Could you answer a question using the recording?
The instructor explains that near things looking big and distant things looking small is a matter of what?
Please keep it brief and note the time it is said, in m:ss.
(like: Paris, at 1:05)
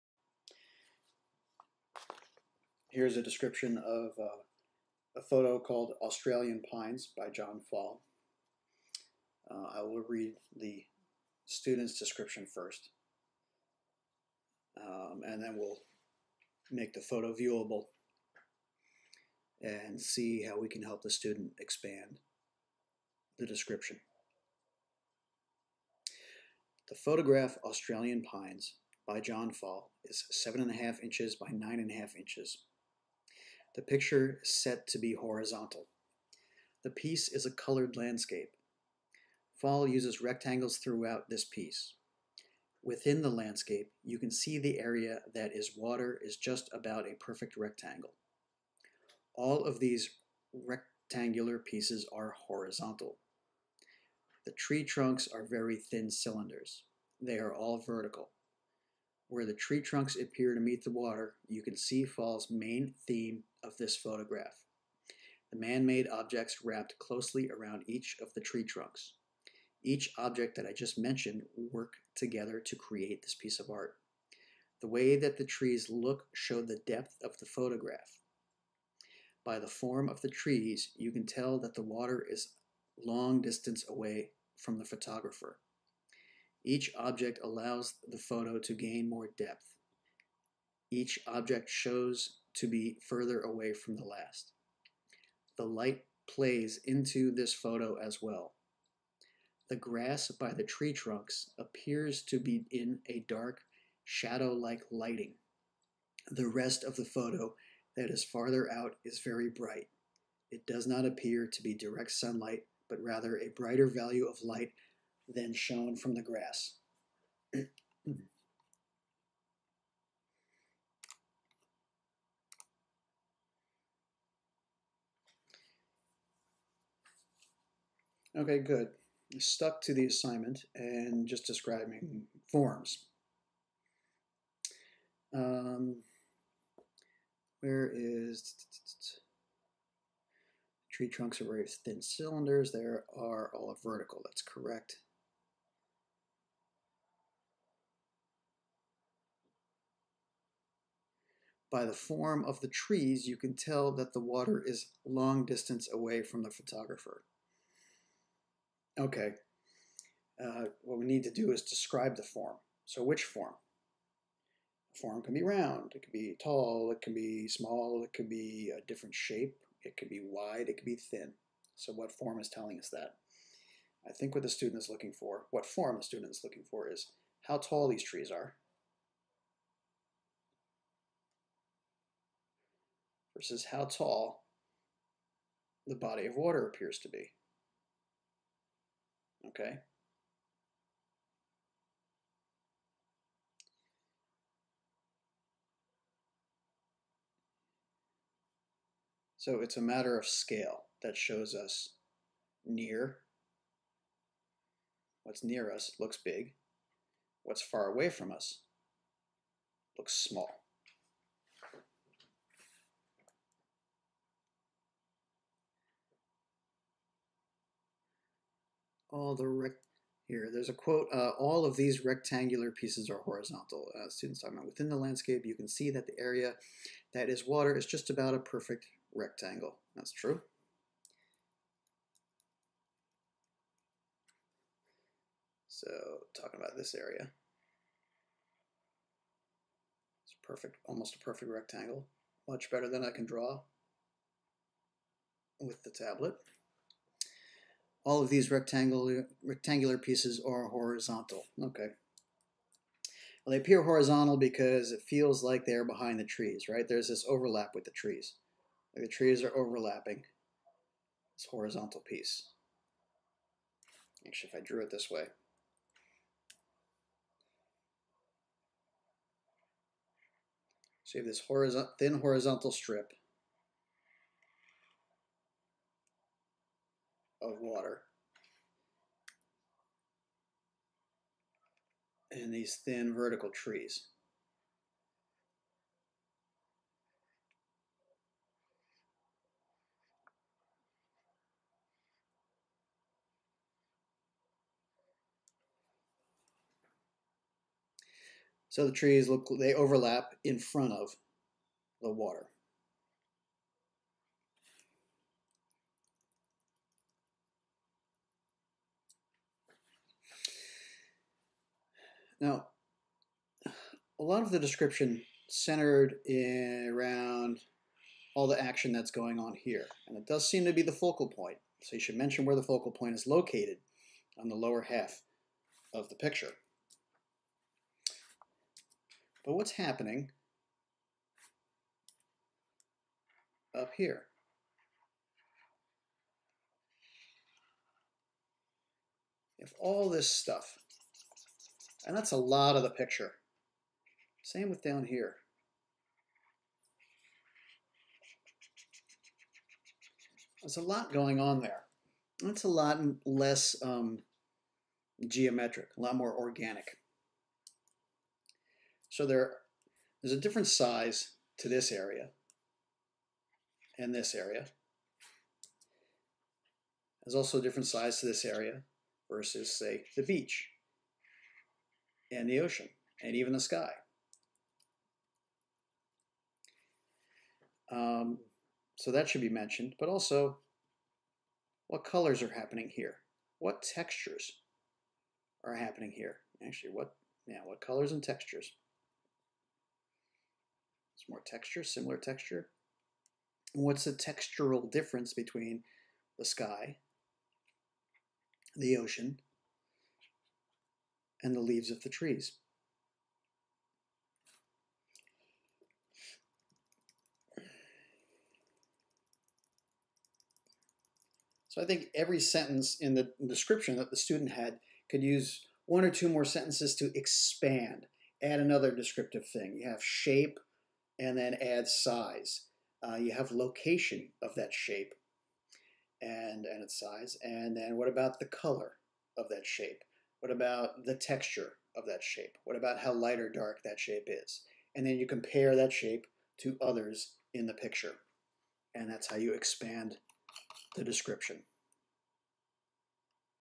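Scale, at 3:20.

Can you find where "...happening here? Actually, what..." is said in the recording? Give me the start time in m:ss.
6:25.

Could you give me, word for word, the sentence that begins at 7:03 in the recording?
Uh, you have location of that shape and, and its size.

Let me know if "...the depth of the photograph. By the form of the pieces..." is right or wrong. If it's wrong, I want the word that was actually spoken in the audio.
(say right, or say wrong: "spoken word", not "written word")
wrong: "trees", not "pieces".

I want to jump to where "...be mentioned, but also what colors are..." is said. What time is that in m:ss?
6:19.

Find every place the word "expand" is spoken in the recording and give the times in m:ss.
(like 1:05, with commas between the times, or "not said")
0:21, 6:57, 7:19.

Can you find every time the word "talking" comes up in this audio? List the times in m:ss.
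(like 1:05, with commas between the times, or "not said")
3:44, 3:56.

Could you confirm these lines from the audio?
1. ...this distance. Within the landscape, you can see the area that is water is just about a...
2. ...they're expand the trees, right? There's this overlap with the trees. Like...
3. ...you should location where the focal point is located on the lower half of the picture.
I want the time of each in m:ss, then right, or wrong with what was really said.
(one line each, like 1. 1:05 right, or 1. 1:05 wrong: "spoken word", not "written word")
1. 0:41 wrong: "piece", not "distance"
2. 4:15 wrong: "behind", not "expand"
3. 5:21 wrong: "mention", not "location".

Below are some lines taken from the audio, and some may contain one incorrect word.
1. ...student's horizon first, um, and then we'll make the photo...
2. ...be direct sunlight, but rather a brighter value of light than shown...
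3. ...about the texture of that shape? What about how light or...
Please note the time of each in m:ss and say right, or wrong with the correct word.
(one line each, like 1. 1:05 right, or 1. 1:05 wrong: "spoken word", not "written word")
1. 0:11 wrong: "description", not "horizon"
2. 1:51 right
3. 7:10 right.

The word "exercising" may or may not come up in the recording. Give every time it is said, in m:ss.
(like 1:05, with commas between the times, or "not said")
not said.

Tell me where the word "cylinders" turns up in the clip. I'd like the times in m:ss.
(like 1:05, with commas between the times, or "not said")
0:56, 2:22.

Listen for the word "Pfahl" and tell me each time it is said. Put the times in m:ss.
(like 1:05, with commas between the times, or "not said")
0:07, 0:29, 0:39, 1:02.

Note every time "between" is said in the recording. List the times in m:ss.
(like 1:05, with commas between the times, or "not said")
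6:35.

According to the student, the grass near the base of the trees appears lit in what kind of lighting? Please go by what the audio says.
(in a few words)
Dark, shadow-like.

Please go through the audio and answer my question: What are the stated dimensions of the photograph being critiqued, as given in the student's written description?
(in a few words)
7.5 inches by 9.5 inches.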